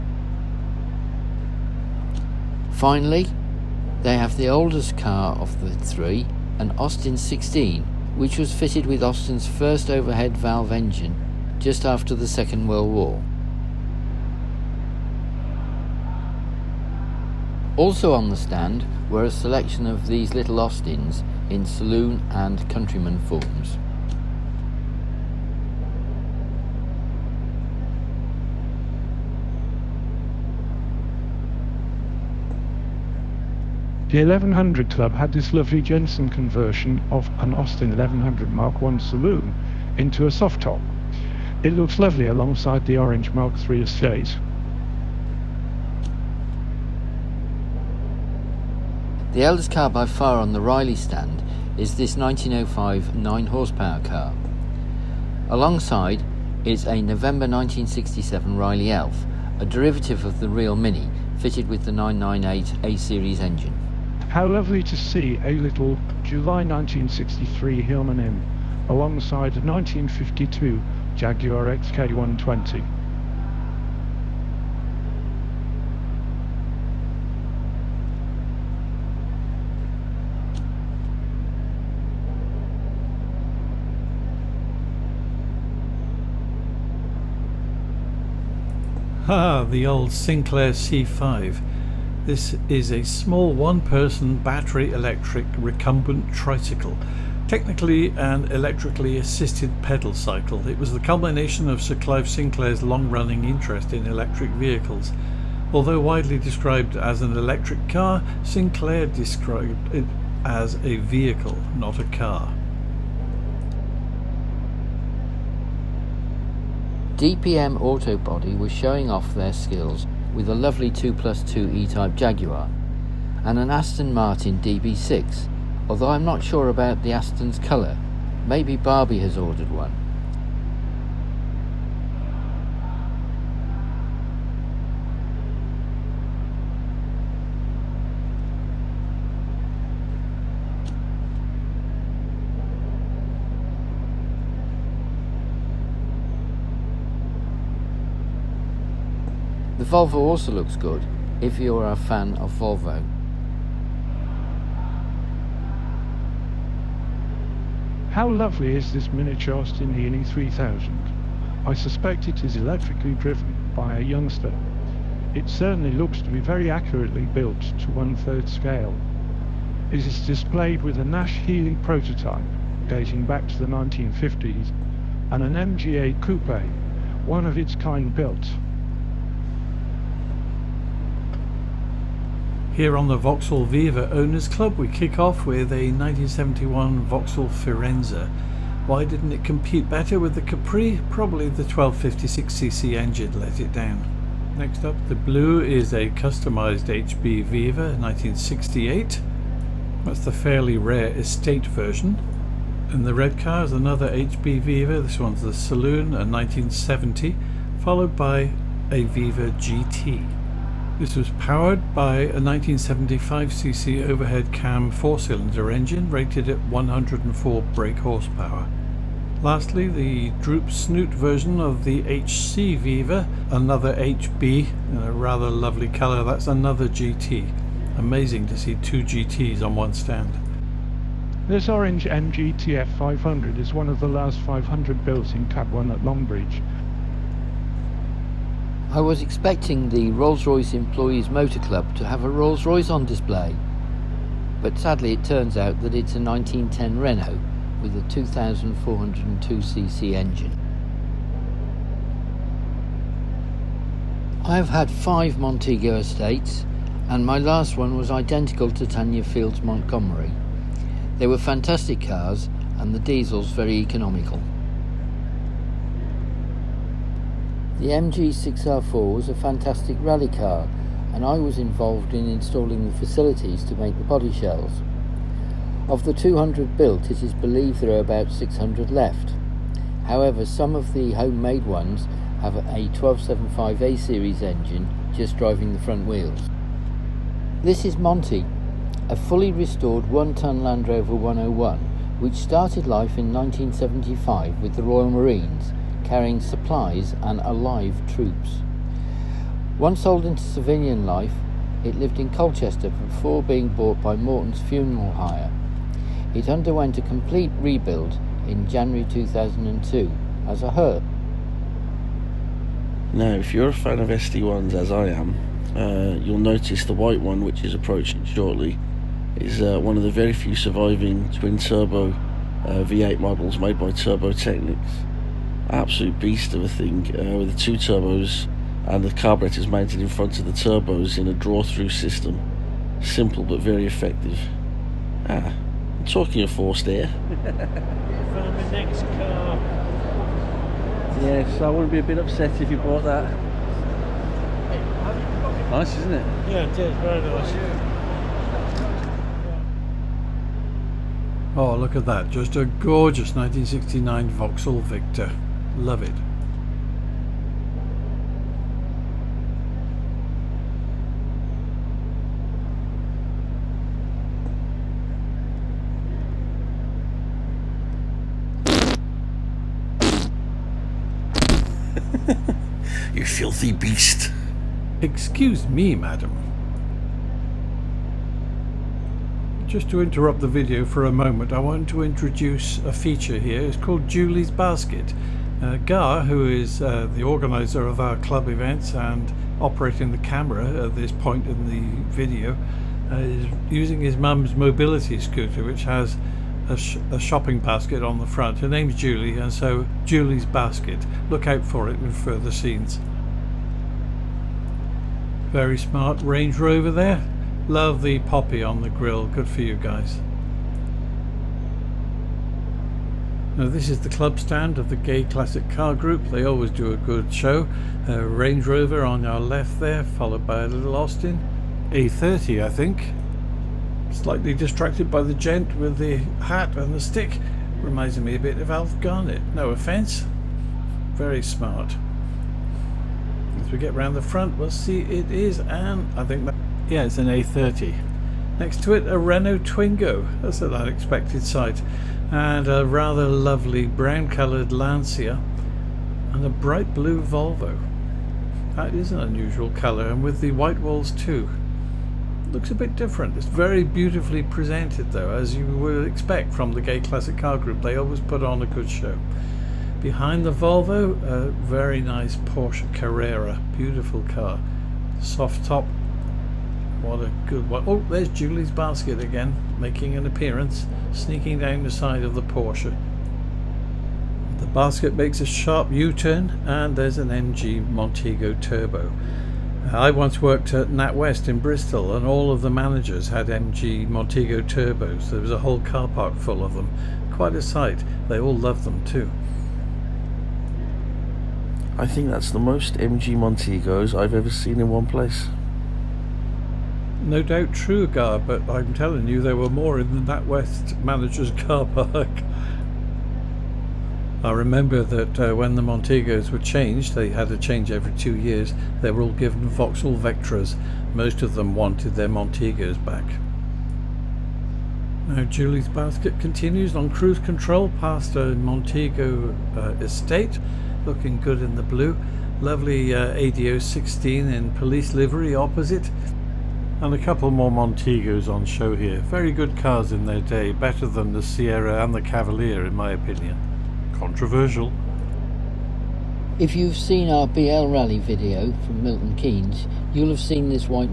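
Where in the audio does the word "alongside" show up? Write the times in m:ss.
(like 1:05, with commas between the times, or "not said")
0:42, 0:55, 1:08.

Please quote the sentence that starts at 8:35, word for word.
Now Julie's basket continues on cruise control past a Montego uh, estate, looking good in the blue.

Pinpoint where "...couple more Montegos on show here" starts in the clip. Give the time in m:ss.
8:47.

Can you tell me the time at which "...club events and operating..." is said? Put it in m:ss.
6:28.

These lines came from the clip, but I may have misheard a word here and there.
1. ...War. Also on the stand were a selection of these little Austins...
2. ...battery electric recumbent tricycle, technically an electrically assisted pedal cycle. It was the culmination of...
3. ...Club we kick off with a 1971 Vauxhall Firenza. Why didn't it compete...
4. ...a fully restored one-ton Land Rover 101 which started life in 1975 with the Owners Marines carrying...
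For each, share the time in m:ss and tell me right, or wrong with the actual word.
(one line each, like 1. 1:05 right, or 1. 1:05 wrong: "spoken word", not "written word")
1. 0:12 right
2. 1:34 right
3. 3:04 right
4. 4:49 wrong: "Royal", not "Owners".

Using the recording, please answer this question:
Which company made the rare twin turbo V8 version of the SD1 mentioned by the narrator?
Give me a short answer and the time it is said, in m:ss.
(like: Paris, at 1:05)
Turbo Technics, at 5:23.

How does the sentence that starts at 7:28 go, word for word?
That is an unusual colour and with the white walls too.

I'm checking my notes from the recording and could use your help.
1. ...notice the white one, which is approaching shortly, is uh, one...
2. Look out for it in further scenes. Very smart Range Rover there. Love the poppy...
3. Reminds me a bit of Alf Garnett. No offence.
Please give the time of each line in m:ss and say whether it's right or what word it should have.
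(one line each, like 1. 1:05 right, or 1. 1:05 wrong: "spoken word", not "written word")
1. 5:16 right
2. 6:41 right
3. 7:07 right.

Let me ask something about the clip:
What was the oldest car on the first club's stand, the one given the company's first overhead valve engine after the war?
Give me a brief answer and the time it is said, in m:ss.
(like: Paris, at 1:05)
Austin 16, at 0:06.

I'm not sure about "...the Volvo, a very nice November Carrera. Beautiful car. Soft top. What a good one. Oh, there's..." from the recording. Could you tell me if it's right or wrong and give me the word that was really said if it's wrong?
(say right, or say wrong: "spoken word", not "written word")
wrong: "Porsche", not "November".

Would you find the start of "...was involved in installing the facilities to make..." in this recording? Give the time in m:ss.
4:31.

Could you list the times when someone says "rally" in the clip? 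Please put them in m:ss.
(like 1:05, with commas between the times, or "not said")
4:30, 8:57.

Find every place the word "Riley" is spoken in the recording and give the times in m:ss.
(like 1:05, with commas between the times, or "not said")
0:50, 0:58.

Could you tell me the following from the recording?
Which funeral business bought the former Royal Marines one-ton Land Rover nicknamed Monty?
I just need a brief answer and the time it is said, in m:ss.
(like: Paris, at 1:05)
Morton's Funeral Hire, at 5:04.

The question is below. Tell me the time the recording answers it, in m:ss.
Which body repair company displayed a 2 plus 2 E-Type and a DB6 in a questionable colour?
1:57.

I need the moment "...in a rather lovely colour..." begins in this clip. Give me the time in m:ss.
3:44.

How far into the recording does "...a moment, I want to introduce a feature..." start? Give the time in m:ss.
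6:21.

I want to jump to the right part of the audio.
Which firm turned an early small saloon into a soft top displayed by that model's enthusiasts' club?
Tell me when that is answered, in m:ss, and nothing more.
0:35.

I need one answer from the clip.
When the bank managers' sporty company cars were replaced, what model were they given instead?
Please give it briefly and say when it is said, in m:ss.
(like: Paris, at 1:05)
Vauxhall Vectras, at 8:29.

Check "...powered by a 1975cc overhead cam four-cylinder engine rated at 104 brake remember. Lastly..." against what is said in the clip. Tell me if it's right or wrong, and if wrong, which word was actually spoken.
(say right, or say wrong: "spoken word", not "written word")
wrong: "horsepower", not "remember".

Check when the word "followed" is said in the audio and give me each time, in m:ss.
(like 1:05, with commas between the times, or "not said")
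3:27, 7:00.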